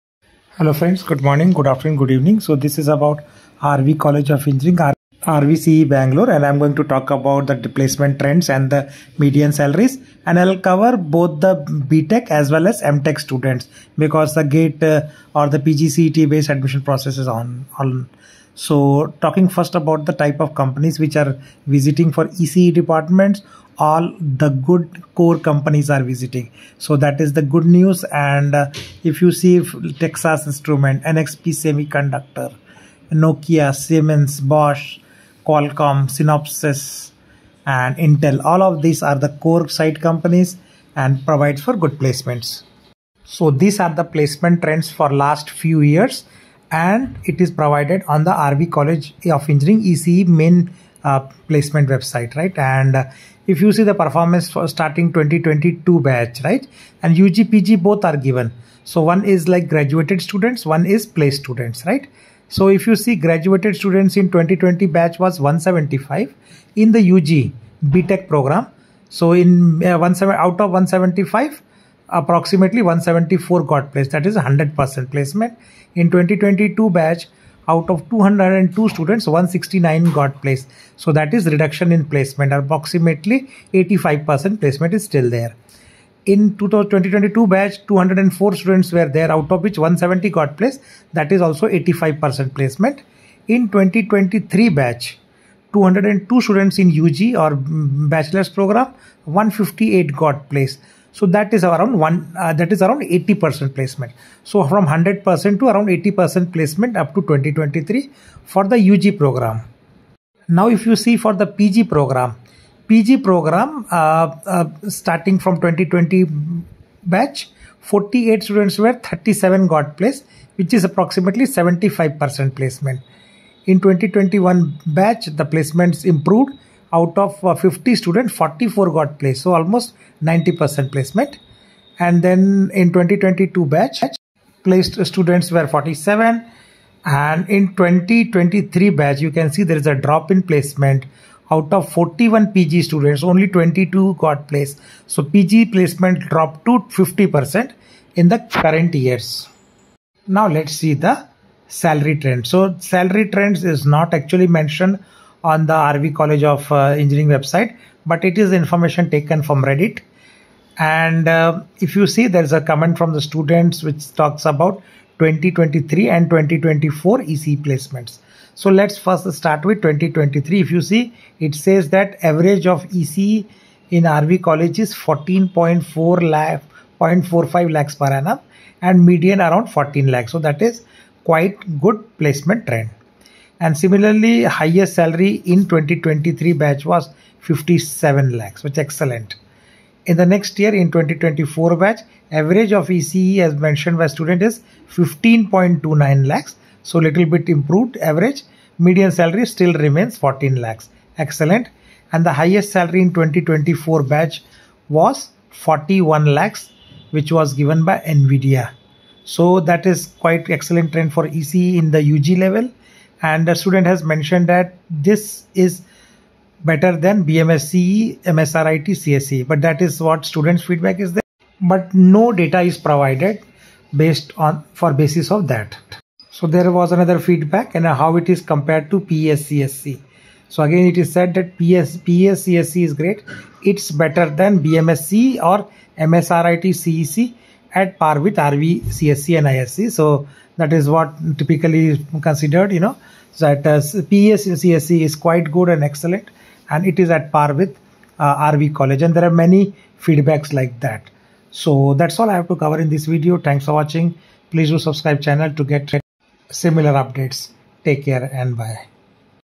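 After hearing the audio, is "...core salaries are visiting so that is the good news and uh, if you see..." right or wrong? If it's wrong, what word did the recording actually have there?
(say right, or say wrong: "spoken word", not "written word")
wrong: "companies", not "salaries".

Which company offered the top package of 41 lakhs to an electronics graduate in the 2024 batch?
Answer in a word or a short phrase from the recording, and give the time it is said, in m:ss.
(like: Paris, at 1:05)
NVIDIA, at 3:27.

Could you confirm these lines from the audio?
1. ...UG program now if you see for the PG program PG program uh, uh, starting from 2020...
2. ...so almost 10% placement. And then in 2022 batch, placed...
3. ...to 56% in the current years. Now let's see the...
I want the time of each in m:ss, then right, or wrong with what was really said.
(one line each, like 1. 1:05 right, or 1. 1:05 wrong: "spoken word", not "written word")
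1. 1:48 right
2. 2:09 wrong: "90", not "10"
3. 2:26 wrong: "50", not "56".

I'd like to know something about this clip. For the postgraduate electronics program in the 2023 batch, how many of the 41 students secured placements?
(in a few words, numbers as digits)
22.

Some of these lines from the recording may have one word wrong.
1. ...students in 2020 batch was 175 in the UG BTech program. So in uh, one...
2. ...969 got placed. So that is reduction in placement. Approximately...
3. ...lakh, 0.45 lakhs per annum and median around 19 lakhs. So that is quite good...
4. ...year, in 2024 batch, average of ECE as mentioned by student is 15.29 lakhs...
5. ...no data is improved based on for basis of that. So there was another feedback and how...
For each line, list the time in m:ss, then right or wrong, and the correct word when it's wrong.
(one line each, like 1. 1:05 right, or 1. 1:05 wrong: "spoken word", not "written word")
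1. 1:03 right
2. 1:19 wrong: "169", not "969"
3. 2:56 wrong: "14", not "19"
4. 3:10 right
5. 3:41 wrong: "provided", not "improved".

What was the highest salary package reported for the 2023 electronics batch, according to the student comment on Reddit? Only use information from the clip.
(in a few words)
57 lakhs.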